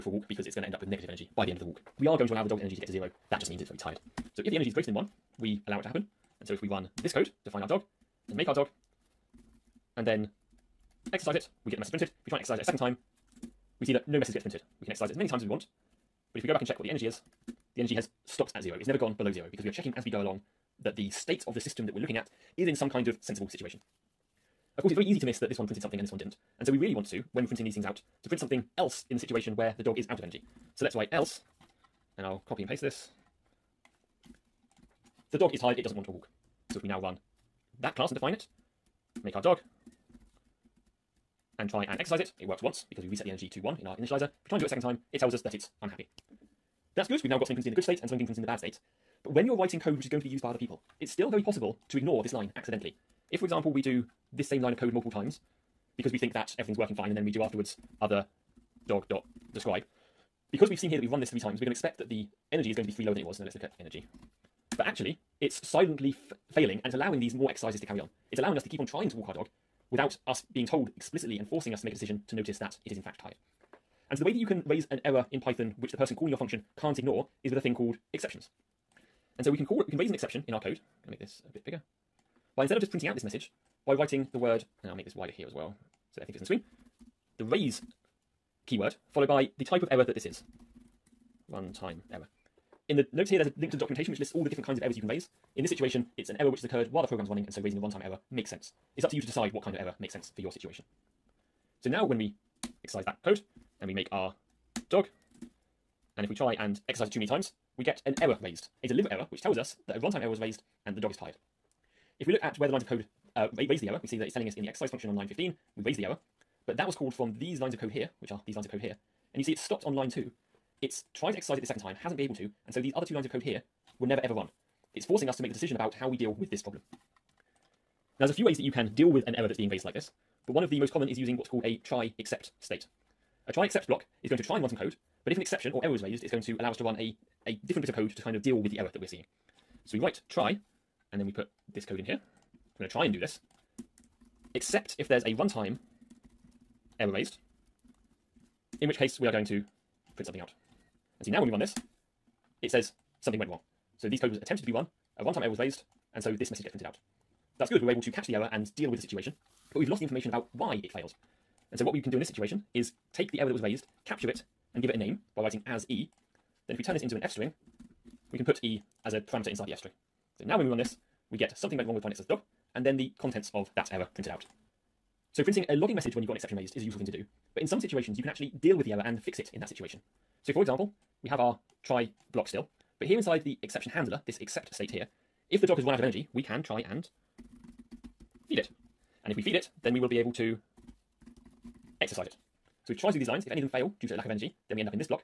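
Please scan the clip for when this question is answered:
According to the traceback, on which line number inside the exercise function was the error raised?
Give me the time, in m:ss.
1:55.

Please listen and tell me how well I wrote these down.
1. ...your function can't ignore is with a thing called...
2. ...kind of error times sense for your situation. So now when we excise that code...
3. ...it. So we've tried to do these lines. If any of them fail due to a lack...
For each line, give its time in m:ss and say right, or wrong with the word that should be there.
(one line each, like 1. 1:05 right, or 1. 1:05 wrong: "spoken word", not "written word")
1. 1:16 right
2. 1:39 wrong: "makes", not "times"
3. 3:12 right.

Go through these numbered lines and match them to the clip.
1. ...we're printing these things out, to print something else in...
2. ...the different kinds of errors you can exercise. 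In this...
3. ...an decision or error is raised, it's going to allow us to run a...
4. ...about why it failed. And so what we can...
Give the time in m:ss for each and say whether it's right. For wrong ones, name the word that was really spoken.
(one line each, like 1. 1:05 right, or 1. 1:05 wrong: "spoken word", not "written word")
1. 0:27 right
2. 1:34 wrong: "raise", not "exercise"
3. 2:15 wrong: "exception", not "decision"
4. 2:40 right.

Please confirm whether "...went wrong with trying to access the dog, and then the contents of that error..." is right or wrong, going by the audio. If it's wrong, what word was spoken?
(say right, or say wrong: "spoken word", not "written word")
right.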